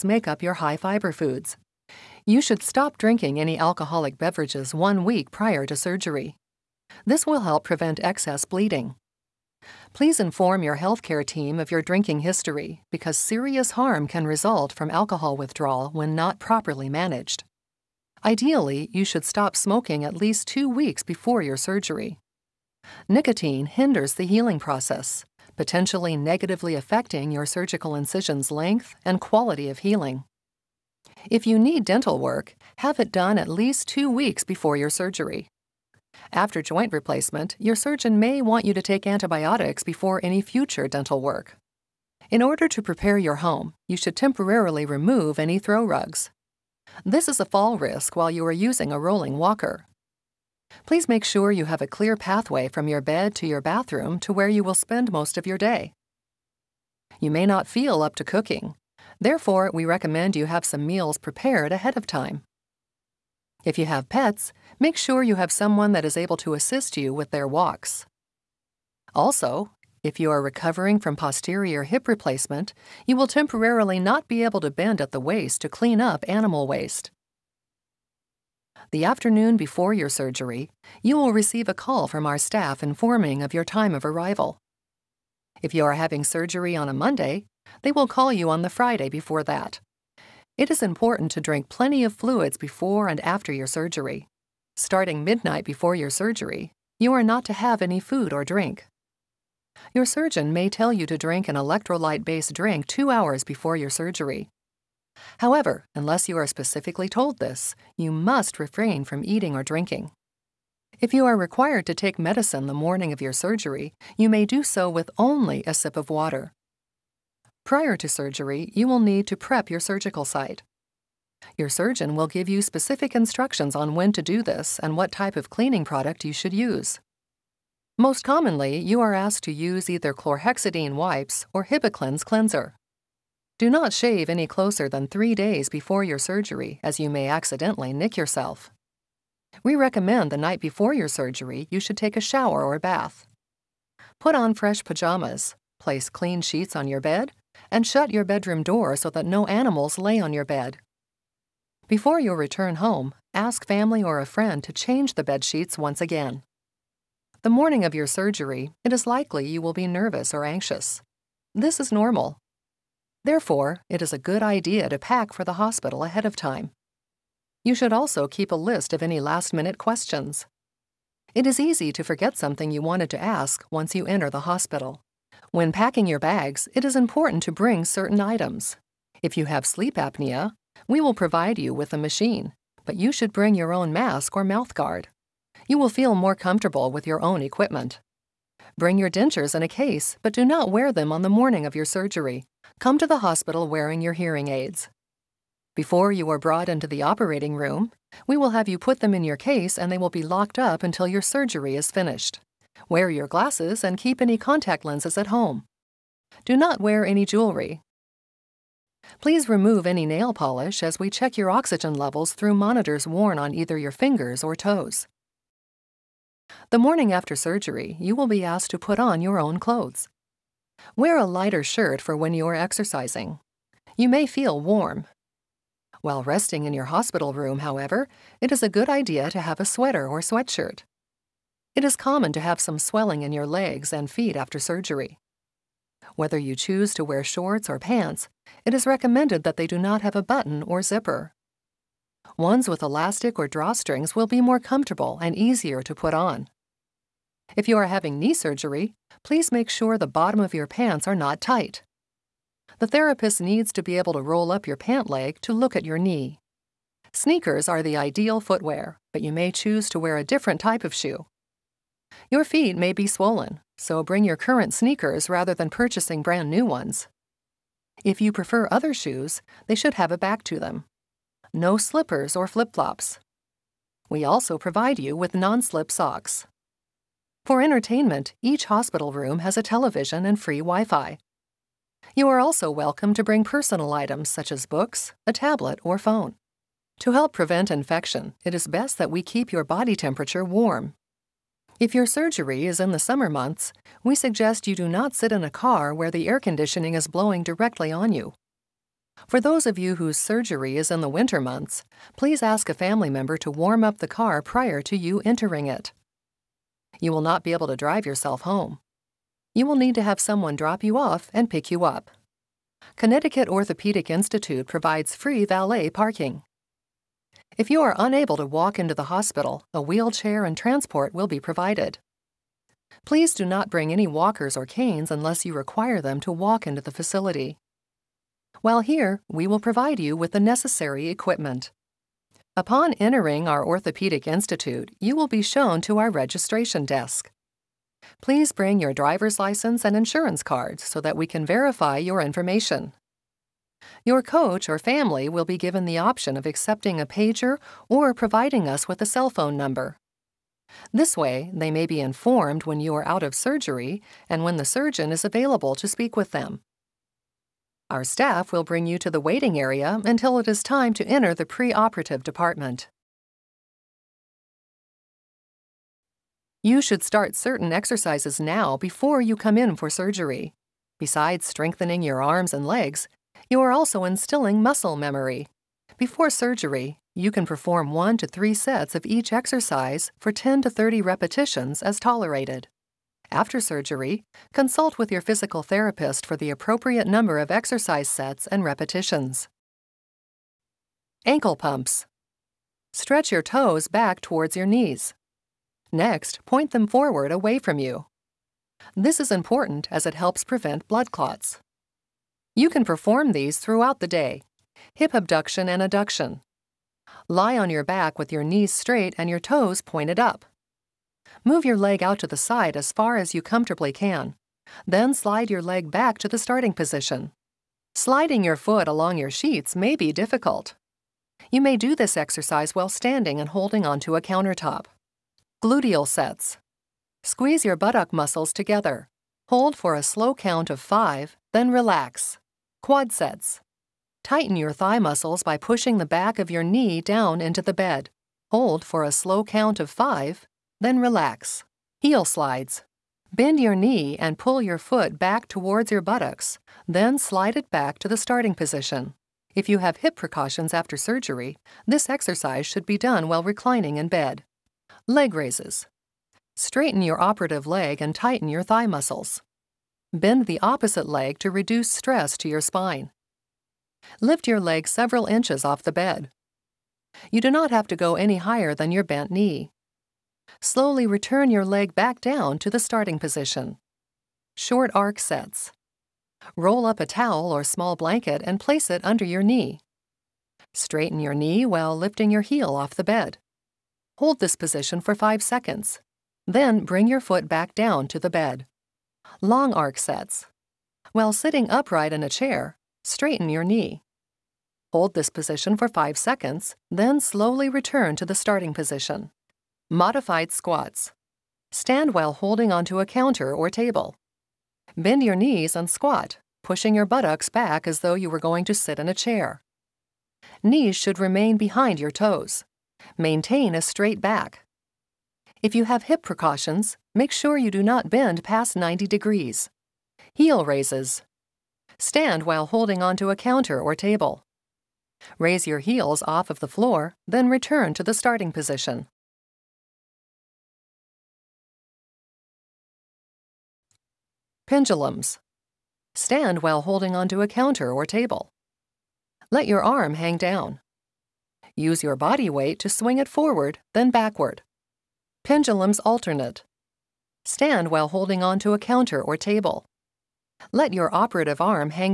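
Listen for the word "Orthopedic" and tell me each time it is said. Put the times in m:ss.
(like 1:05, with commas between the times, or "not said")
5:13, 5:33.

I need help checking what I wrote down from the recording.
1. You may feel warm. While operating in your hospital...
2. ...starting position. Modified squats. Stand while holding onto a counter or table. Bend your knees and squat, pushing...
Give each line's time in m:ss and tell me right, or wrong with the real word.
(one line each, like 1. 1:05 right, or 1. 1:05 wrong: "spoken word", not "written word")
1. 3:43 wrong: "resting", not "operating"
2. 8:18 right.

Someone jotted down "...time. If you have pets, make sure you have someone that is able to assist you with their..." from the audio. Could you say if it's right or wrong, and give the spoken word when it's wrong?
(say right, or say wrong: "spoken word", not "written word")
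right.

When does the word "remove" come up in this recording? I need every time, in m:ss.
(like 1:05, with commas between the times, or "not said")
0:44, 3:29.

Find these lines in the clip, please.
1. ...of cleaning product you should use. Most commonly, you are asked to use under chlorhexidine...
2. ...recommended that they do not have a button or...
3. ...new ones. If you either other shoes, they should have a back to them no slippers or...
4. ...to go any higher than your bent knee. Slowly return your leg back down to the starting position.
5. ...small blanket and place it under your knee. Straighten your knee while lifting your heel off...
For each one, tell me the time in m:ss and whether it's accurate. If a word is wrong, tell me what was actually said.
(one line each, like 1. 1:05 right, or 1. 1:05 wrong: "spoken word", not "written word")
1. 2:05 wrong: "either", not "under"
2. 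3:58 right
3. 4:26 wrong: "prefer", not "either"
4. 7:47 right
5. 7:57 right.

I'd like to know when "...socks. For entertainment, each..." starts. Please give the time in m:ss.
4:35.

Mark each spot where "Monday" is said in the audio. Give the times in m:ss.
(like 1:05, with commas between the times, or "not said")
1:26.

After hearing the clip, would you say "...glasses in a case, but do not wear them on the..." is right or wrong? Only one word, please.
wrong.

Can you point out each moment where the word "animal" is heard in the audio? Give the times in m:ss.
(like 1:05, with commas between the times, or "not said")
1:16, 2:29.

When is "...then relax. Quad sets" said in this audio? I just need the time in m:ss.
7:11.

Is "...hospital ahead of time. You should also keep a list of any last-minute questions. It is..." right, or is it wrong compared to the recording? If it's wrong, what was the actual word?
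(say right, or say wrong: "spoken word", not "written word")
right.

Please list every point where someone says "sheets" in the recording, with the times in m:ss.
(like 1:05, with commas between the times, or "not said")
2:26, 2:35, 6:59.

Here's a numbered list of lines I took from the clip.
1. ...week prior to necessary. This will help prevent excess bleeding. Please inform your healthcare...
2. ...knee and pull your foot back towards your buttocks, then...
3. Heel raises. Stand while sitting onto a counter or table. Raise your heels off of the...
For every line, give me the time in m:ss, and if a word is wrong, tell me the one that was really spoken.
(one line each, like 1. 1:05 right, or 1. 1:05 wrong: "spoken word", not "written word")
1. 0:05 wrong: "surgery", not "necessary"
2. 7:23 right
3. 8:40 wrong: "holding", not "sitting".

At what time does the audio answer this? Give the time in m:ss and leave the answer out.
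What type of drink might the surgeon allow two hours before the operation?
1:41.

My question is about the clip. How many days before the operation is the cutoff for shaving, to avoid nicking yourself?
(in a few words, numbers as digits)
3 days.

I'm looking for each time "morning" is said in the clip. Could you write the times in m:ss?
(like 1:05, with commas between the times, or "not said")
1:52, 2:37, 3:11, 3:36.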